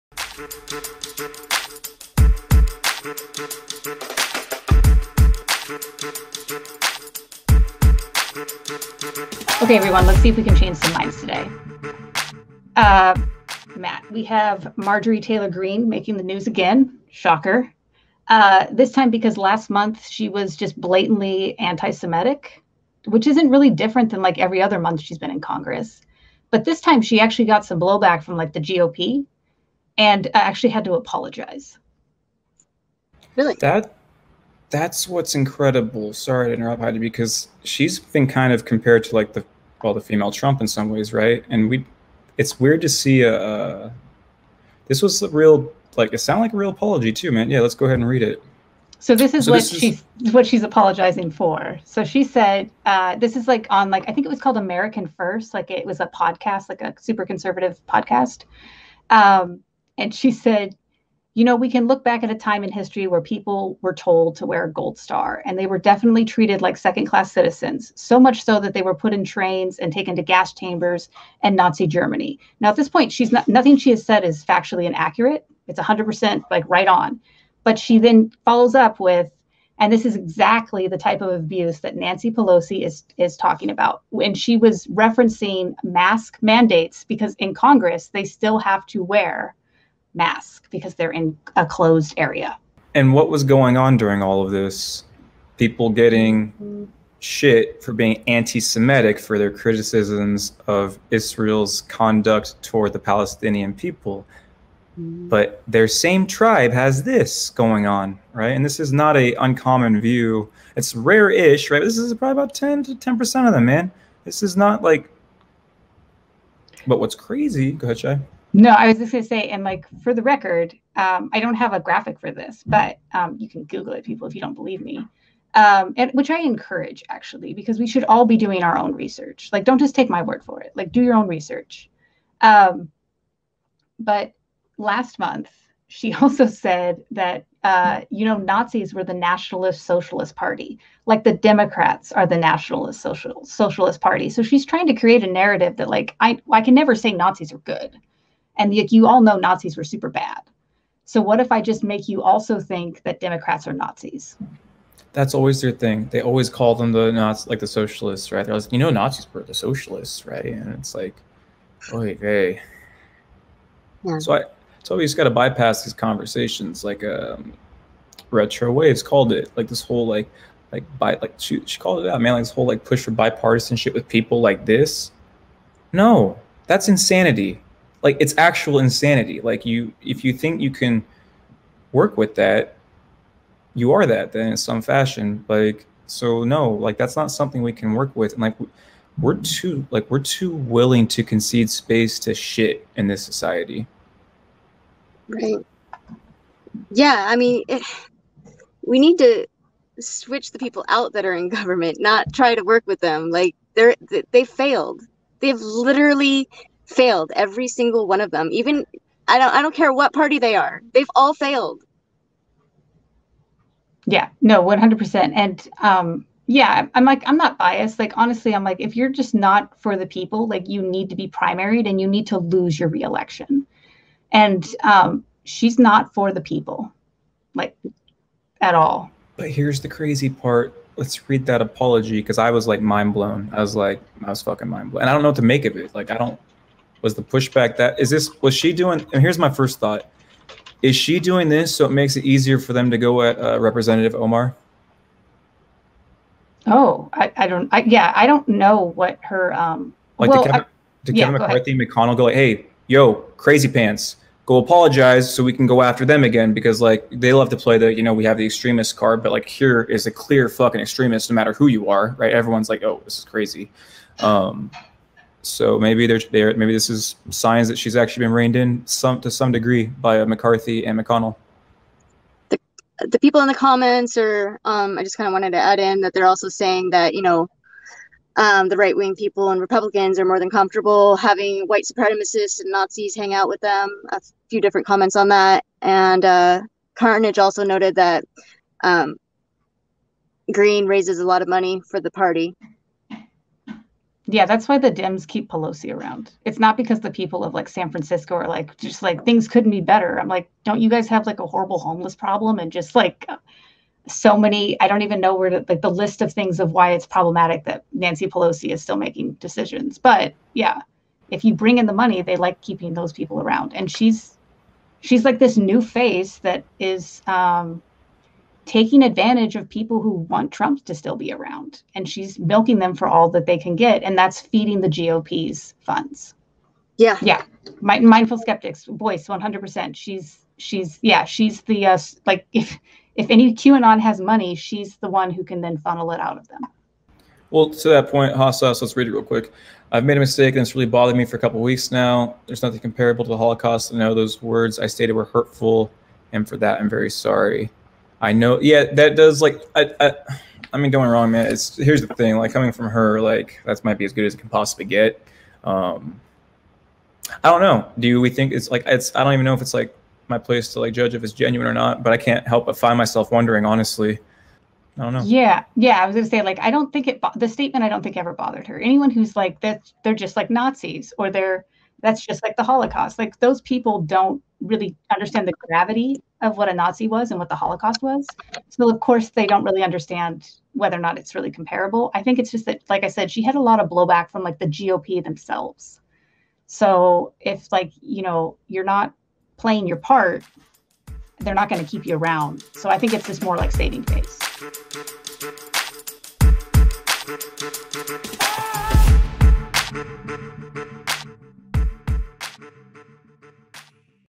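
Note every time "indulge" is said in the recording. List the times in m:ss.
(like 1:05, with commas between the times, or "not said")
not said.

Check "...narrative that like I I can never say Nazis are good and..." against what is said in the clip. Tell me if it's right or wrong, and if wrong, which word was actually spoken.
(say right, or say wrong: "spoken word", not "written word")
right.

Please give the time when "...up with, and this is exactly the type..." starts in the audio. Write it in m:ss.
1:18.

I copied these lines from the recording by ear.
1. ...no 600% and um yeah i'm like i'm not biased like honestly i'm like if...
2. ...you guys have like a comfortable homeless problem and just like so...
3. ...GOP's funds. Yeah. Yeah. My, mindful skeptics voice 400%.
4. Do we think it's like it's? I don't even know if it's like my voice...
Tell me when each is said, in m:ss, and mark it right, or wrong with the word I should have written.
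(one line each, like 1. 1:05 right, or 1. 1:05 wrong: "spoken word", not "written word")
1. 3:34 wrong: "100", not "600"
2. 5:00 wrong: "horrible", not "comfortable"
3. 5:24 wrong: "100", not "400"
4. 5:57 wrong: "place", not "voice".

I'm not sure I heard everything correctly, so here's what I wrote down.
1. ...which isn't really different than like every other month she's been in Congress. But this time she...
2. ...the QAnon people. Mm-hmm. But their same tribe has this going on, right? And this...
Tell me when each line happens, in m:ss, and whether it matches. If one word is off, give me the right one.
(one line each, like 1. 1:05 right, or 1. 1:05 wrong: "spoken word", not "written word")
1. 0:23 right
2. 1:42 wrong: "Palestinian", not "QAnon".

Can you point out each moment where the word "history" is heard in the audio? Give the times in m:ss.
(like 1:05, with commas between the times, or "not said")
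1:02.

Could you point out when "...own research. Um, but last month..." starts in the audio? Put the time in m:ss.
2:11.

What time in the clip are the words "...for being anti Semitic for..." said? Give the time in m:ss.
1:37.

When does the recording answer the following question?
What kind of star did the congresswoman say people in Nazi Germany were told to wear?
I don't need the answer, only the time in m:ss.
1:04.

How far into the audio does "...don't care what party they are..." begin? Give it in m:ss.
3:29.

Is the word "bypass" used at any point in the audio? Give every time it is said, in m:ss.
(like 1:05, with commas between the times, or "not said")
2:45.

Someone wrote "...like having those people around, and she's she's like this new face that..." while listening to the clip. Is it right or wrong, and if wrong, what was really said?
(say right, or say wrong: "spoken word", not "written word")
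wrong: "keeping", not "having".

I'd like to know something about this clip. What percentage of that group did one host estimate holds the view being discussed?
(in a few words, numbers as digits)
10 percent.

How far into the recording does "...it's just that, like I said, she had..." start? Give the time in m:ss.
6:22.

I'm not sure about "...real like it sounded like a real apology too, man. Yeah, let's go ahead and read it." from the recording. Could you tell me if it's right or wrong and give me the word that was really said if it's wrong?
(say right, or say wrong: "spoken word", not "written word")
right.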